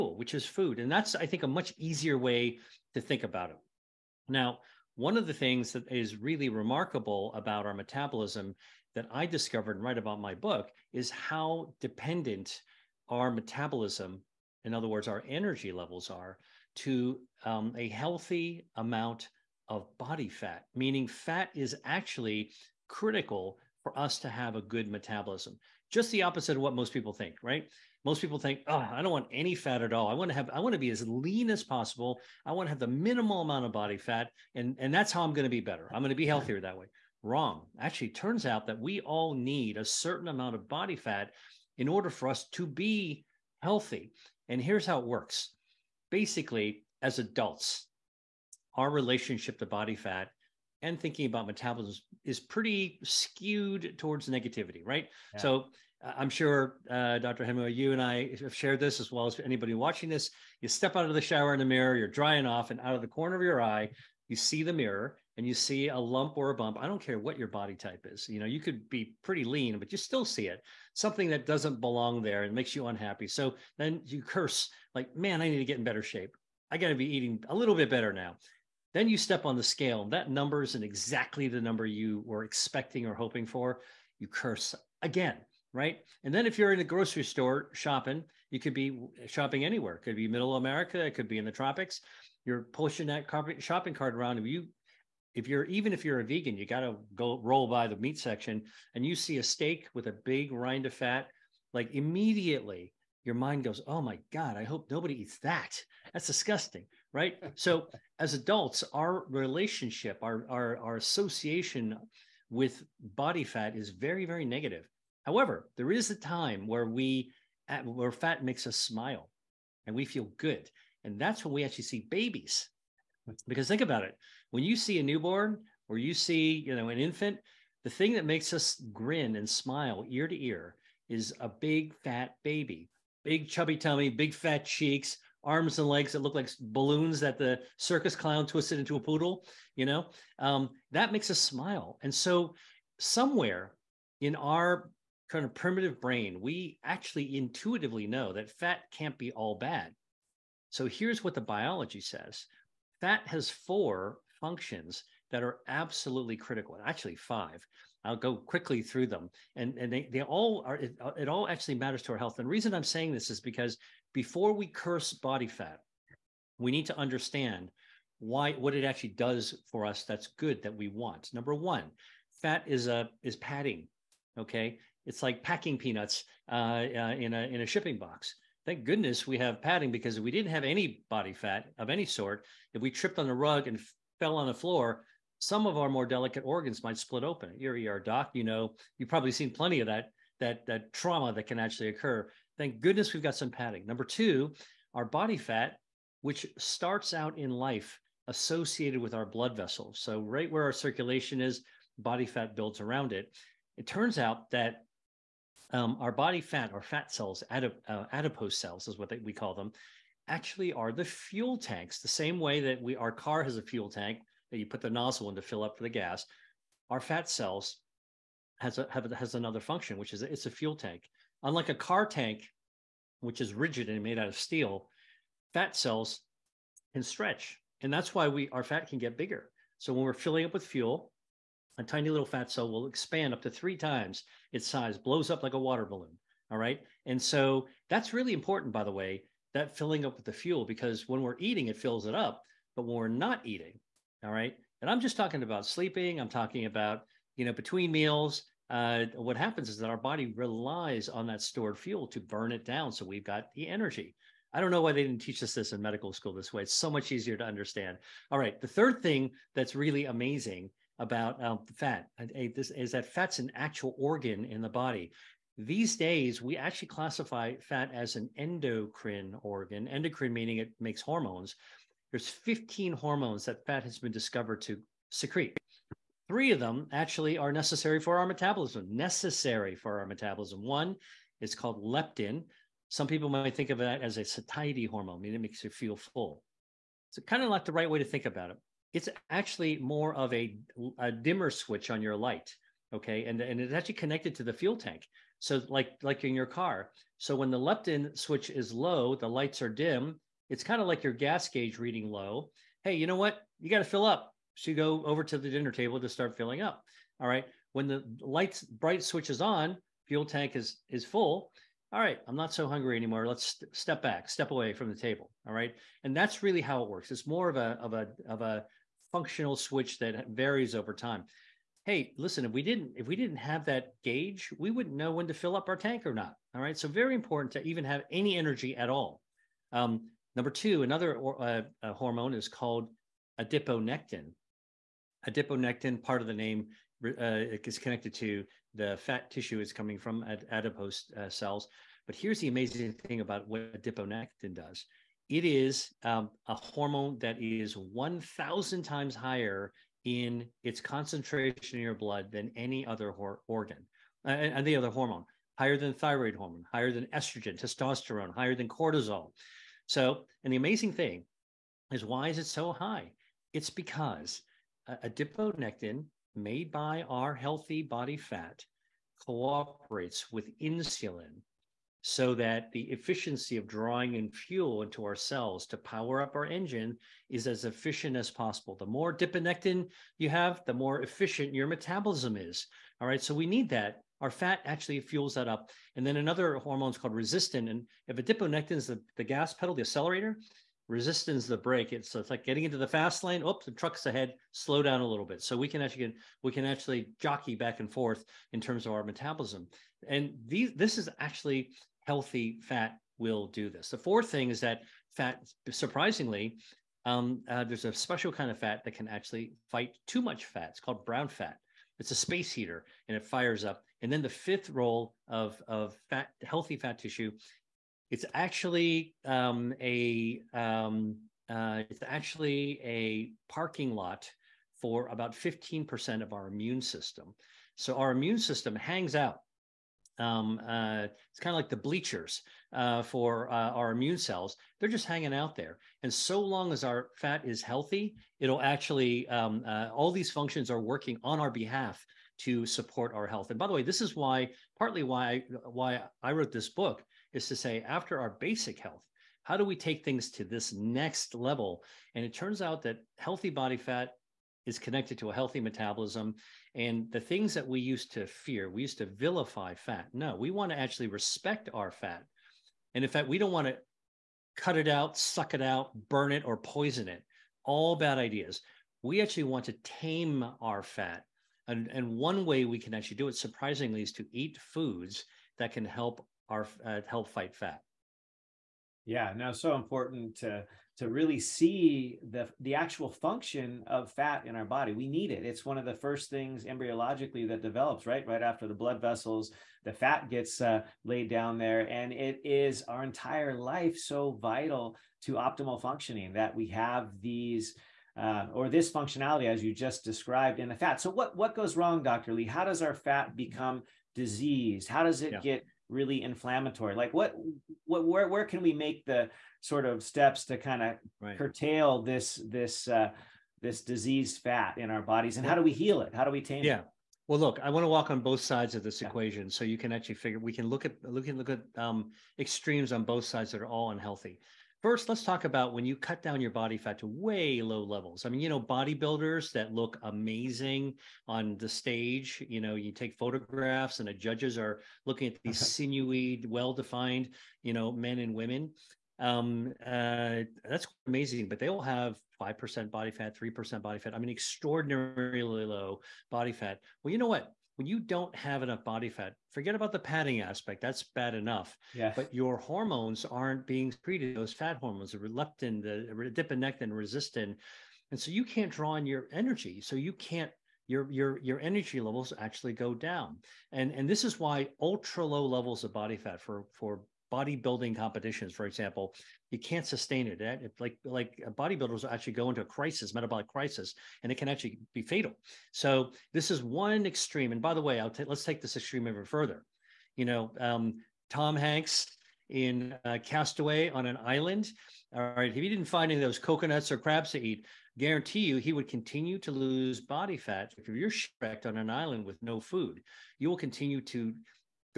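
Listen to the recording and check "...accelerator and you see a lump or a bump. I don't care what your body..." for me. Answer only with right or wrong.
wrong.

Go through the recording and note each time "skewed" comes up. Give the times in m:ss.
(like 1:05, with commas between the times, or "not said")
0:53.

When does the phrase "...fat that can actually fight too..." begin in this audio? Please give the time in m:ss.
6:48.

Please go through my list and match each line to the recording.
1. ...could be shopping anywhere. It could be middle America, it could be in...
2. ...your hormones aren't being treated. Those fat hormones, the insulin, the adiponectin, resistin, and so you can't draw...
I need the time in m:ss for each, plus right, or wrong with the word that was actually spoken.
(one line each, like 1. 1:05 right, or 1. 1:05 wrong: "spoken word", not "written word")
1. 1:28 right
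2. 9:12 wrong: "leptin", not "insulin".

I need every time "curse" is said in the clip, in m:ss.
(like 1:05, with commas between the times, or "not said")
1:14, 1:24, 2:44.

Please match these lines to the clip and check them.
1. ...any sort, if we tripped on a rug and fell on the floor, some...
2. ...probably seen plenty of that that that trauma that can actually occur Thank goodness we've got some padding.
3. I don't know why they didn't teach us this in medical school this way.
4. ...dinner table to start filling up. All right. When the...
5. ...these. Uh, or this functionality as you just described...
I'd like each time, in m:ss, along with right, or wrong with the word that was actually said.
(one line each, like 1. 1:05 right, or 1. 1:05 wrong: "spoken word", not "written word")
1. 3:01 right
2. 3:09 right
3. 4:14 right
4. 5:05 right
5. 8:17 right.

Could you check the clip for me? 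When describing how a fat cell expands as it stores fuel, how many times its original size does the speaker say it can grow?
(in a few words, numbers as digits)
3 times.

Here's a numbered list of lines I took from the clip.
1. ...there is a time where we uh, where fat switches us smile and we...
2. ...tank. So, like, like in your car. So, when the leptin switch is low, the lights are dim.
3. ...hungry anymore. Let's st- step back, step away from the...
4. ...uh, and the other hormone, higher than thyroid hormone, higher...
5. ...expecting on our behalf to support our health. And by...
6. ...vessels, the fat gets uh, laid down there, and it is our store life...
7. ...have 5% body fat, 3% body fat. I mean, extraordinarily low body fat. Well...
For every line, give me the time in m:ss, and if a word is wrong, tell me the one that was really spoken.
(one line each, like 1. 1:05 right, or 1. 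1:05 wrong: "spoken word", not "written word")
1. 1:55 wrong: "makes", not "switches"
2. 4:54 right
3. 5:12 right
4. 5:54 right
5. 7:20 wrong: "working", not "expecting"
6. 8:08 wrong: "entire", not "store"
7. 9:01 right.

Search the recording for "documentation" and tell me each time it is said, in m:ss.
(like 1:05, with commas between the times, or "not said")
not said.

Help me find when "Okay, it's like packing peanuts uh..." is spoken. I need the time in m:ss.
2:54.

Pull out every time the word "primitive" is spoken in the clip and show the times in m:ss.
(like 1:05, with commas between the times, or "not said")
2:25.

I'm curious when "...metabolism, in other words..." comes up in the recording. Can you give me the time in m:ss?
0:13.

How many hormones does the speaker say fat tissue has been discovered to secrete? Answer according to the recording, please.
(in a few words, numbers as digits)
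15.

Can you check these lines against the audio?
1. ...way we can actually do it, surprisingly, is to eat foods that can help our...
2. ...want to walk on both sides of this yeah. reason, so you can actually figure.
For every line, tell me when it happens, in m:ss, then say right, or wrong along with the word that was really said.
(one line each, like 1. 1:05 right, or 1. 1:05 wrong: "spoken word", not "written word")
1. 7:52 right
2. 8:37 wrong: "equation", not "reason".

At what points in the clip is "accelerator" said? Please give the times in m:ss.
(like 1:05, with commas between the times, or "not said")
6:29.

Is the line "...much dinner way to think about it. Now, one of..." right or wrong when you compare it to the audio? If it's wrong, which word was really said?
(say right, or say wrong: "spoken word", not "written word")
wrong: "easier", not "dinner".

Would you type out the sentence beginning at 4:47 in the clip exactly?
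So, kind of not the right way to think about it.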